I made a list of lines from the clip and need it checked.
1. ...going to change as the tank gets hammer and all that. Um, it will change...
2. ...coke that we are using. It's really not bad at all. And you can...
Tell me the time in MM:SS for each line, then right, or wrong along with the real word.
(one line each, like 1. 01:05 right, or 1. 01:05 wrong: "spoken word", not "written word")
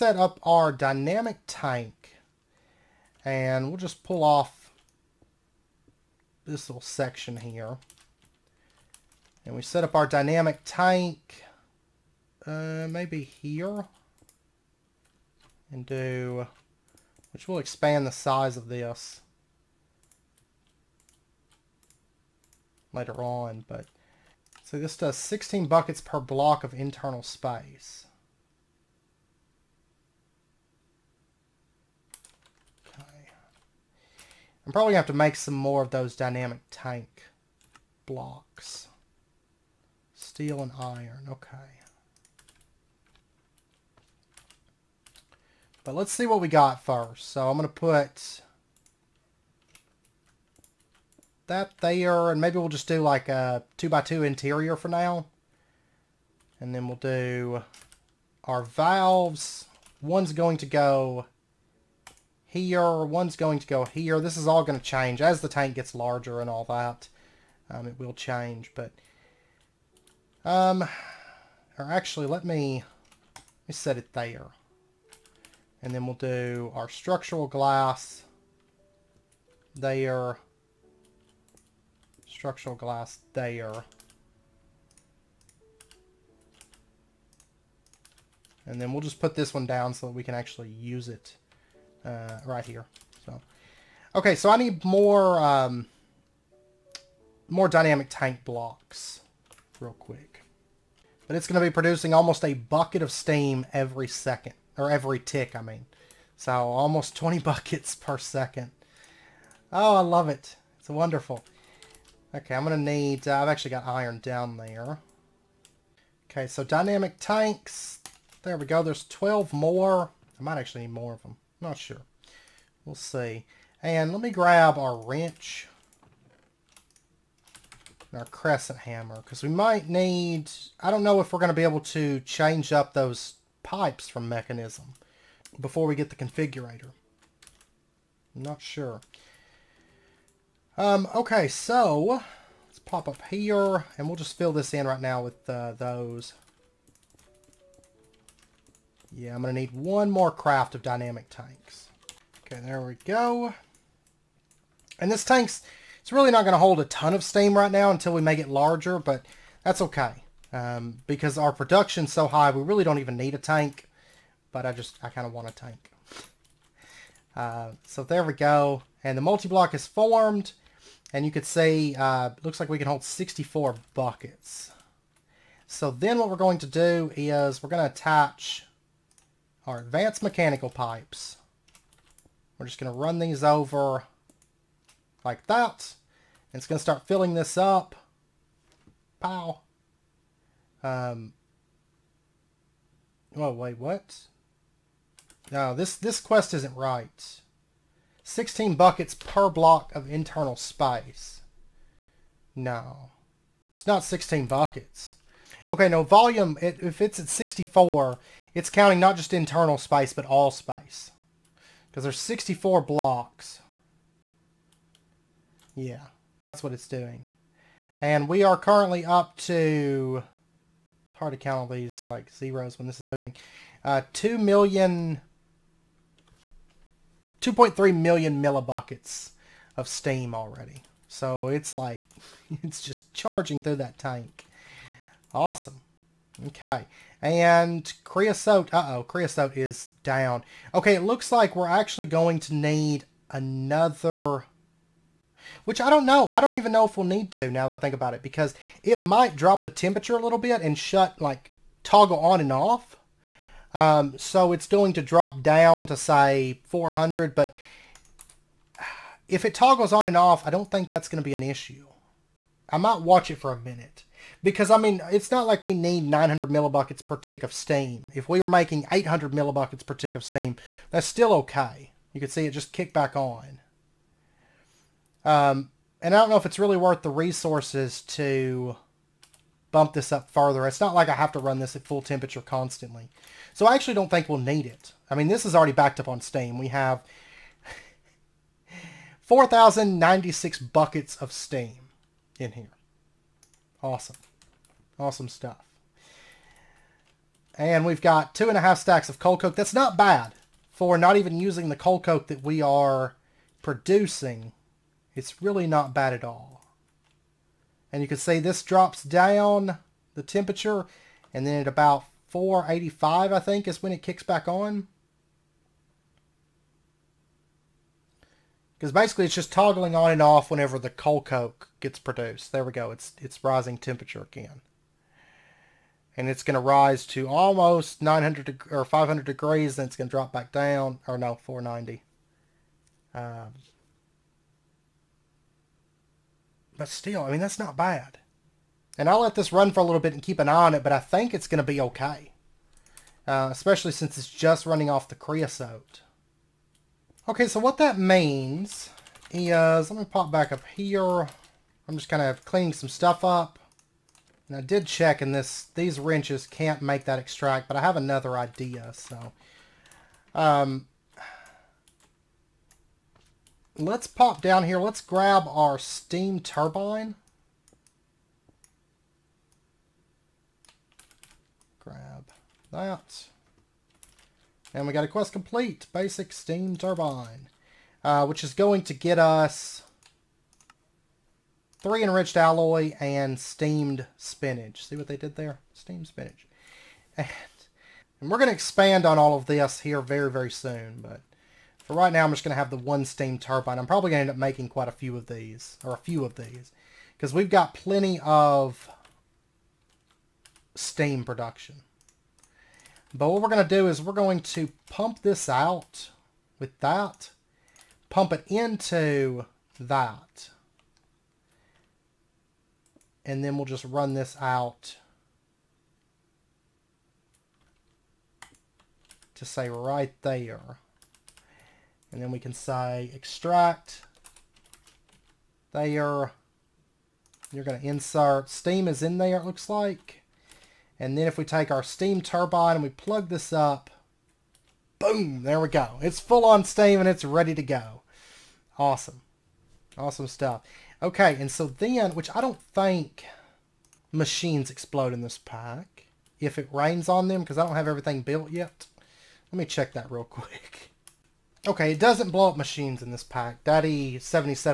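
1. 01:04 wrong: "larger", not "hammer"
2. 05:02 wrong: "producing", not "using".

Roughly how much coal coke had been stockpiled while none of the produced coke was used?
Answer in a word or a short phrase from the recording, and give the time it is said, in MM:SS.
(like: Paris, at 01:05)
two and a half stacks, at 04:58.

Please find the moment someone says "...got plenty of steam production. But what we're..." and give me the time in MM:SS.
06:37.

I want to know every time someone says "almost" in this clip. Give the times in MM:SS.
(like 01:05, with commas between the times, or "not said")
01:42, 01:46, 05:27.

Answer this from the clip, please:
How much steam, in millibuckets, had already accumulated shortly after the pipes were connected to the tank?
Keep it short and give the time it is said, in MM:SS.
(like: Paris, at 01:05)
2.3 million, at 03:47.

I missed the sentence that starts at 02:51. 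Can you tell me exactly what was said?
And you could say, uh, looks like we can hold 64 buckets.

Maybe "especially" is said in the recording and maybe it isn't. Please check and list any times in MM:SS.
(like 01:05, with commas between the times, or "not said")
05:43.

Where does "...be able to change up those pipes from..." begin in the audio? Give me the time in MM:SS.
02:11.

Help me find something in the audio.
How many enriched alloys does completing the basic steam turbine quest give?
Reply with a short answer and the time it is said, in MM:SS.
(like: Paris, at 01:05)
3, at 06:21.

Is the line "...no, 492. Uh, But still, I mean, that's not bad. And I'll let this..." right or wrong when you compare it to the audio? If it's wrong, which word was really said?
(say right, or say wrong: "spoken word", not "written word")
wrong: "490", not "492".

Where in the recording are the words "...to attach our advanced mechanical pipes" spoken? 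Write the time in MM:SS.
02:57.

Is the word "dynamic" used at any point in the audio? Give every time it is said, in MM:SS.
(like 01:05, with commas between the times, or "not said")
00:00, 00:10, 00:36, 01:37, 01:56, 02:30.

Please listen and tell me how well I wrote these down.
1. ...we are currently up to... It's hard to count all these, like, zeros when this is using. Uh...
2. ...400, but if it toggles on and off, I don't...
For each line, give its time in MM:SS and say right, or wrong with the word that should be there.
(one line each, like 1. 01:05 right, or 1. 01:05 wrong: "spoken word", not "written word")
1. 03:38 wrong: "moving", not "using"
2. 04:16 right.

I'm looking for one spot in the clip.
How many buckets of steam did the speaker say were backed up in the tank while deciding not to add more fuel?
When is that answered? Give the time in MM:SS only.
04:49.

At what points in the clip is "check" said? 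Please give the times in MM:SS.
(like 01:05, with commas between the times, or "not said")
05:54, 07:29.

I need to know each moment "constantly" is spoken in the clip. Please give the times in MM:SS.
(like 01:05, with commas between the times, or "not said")
04:42.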